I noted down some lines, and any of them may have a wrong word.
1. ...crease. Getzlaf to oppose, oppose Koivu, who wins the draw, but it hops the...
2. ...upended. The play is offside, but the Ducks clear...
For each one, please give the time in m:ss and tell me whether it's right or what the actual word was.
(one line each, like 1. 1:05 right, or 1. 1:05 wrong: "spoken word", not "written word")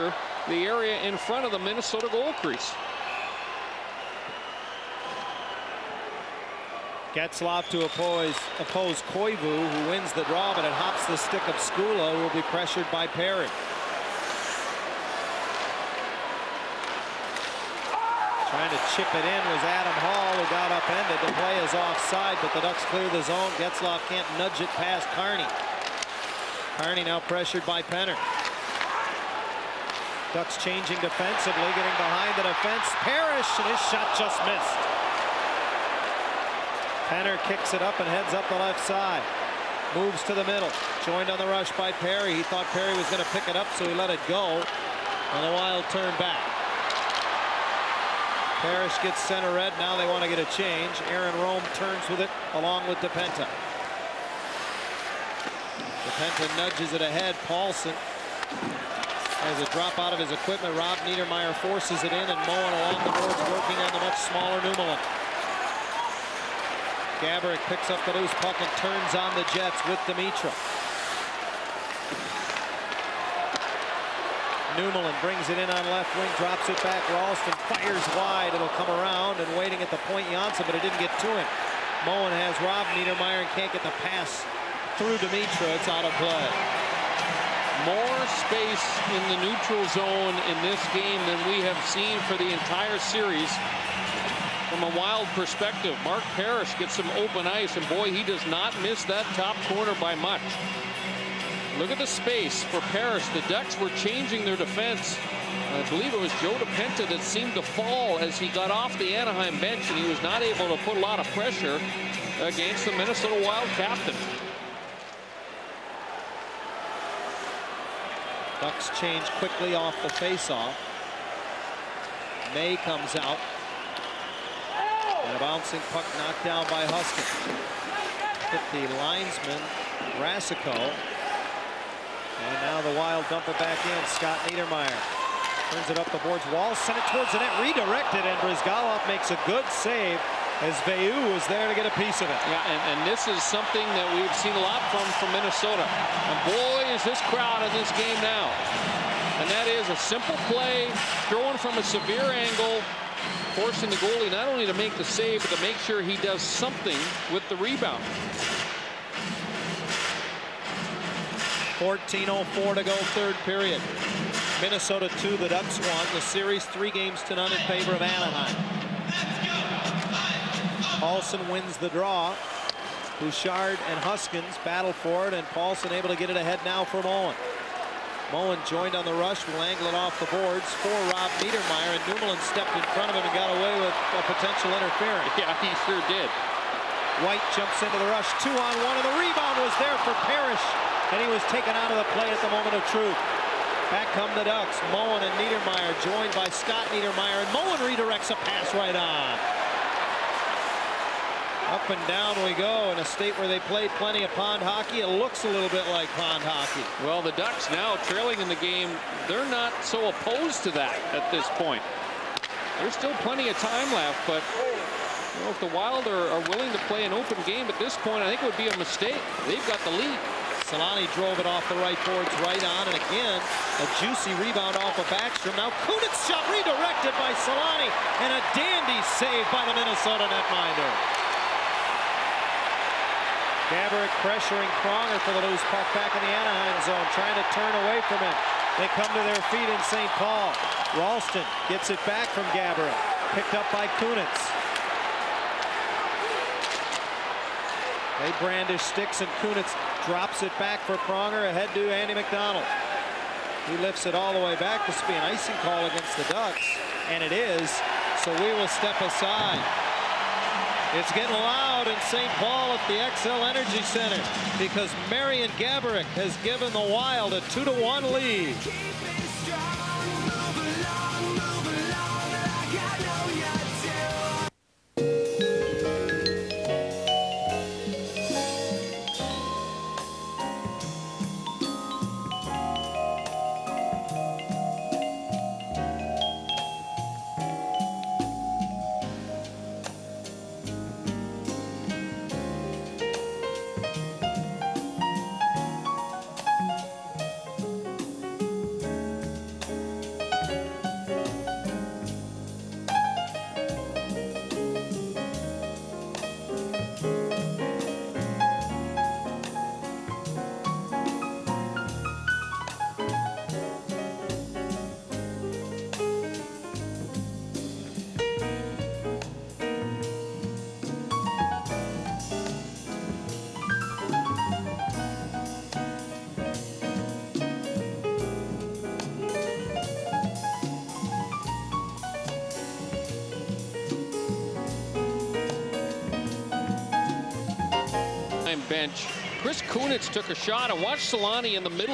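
1. 0:02 right
2. 0:20 right.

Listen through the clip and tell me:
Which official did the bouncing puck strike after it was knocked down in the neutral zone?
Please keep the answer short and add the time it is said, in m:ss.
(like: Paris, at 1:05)
Rasico, at 2:10.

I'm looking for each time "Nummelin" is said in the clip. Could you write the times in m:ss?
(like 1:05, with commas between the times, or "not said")
1:04, 1:14, 3:02.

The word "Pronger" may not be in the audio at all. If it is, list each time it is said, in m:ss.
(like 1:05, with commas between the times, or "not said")
3:54, 4:10.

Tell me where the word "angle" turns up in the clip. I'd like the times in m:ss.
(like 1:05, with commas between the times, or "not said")
2:32, 2:59.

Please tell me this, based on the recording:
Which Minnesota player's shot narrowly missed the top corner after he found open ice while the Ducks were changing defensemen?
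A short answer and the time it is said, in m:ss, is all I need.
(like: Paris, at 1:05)
Mark Parrish, at 1:36.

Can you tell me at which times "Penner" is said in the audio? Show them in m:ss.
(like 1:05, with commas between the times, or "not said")
0:27, 0:37.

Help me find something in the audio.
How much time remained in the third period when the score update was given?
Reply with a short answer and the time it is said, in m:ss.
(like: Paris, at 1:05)
14.04, at 2:41.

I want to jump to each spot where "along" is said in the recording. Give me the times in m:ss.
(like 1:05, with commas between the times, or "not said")
0:52, 1:02.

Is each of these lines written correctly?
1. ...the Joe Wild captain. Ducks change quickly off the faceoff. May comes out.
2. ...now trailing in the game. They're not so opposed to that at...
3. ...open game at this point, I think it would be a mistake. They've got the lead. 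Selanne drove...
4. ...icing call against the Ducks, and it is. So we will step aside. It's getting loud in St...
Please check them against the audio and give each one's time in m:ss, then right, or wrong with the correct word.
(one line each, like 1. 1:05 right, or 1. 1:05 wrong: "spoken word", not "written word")
1. 1:52 wrong: "Minnesota", not "Joe"
2. 3:27 right
3. 3:37 right
4. 4:15 right.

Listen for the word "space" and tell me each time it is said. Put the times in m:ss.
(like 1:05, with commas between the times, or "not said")
1:28, 1:42.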